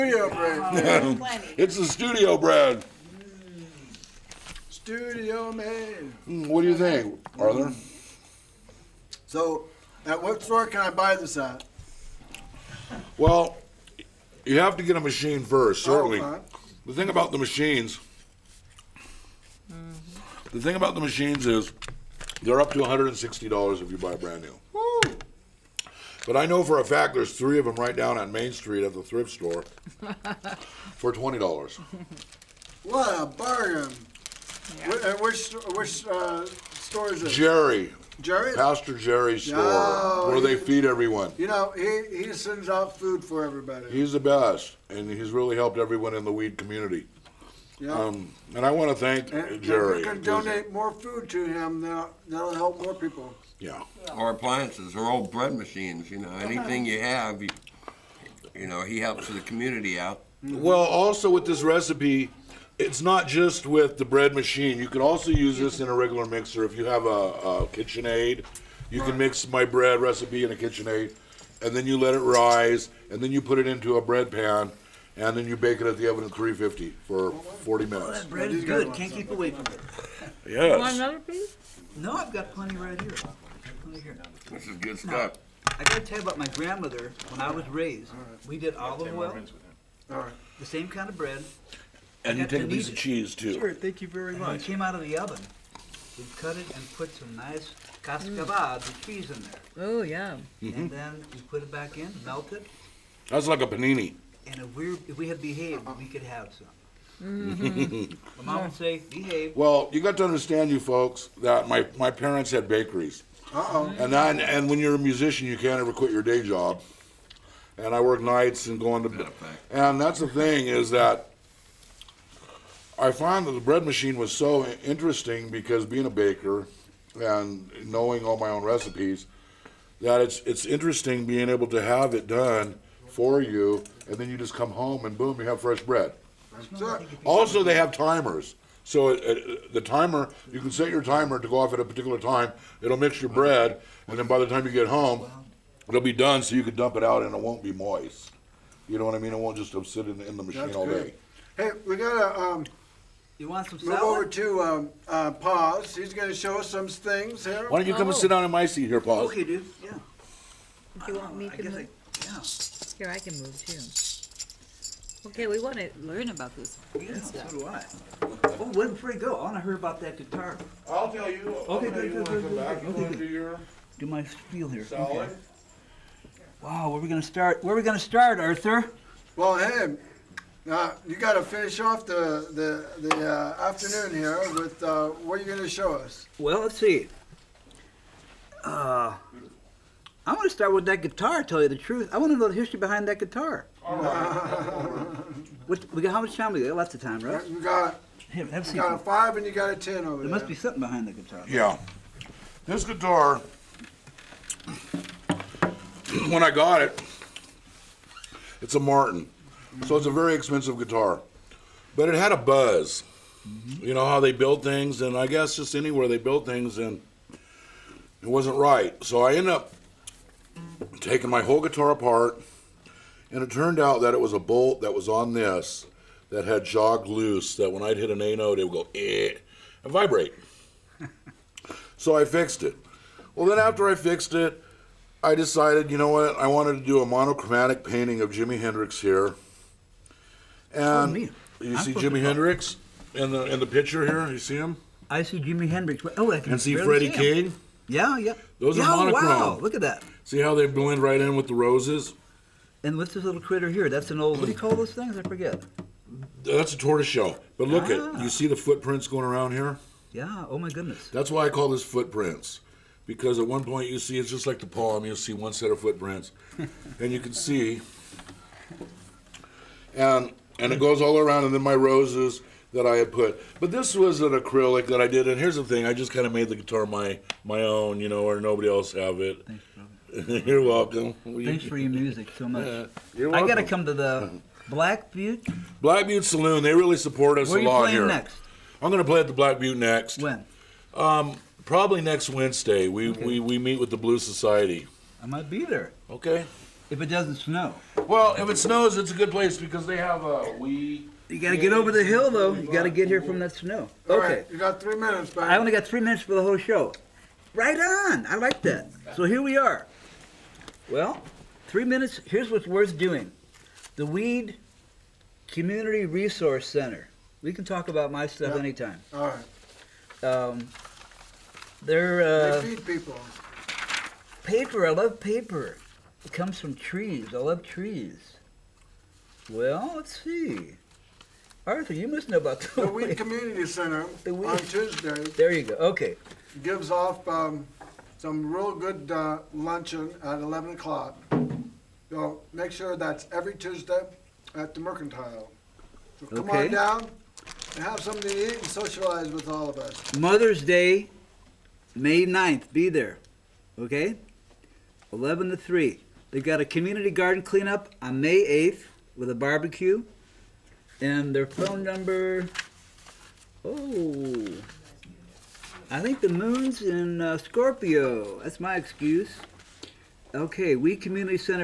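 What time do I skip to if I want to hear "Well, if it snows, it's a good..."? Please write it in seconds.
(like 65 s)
298 s.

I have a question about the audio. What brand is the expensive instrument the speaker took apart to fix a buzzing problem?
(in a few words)
Martin.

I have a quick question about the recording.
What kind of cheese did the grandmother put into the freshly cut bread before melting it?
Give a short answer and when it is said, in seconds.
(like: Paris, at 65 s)
cascaval, at 98 s.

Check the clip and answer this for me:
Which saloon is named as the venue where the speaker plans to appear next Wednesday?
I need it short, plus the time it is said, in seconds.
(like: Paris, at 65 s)
Black Butte Saloon, at 285 s.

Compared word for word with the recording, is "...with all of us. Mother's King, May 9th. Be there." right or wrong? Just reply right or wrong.
wrong.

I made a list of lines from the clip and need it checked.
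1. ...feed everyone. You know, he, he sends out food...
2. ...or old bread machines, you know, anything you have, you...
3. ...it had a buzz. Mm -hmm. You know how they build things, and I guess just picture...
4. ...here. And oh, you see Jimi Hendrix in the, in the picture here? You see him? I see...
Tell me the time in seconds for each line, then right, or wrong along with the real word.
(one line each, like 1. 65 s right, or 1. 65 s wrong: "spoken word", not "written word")
1. 40 s right
2. 54 s right
3. 212 s wrong: "anywhere", not "picture"
4. 238 s right.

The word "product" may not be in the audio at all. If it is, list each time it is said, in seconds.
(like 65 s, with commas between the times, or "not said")
not said.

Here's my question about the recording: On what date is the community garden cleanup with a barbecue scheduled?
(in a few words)
May 8.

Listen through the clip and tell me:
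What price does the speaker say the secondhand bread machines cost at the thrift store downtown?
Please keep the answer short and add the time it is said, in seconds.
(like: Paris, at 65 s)
$20, at 31 s.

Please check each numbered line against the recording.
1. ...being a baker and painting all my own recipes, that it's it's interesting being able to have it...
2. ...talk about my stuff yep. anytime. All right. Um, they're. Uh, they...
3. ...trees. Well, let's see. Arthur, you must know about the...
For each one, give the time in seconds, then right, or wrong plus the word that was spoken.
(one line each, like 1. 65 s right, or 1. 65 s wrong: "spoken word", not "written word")
1. 125 s wrong: "knowing", not "painting"
2. 317 s right
3. 327 s right.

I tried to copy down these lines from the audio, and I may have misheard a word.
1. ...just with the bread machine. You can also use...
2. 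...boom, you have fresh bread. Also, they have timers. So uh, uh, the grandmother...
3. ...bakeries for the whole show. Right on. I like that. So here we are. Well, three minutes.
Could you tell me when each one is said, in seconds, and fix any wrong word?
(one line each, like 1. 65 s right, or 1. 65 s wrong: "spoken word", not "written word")
1. 63 s right
2. 135 s wrong: "timer", not "grandmother"
3. 306 s wrong: "minutes", not "bakeries".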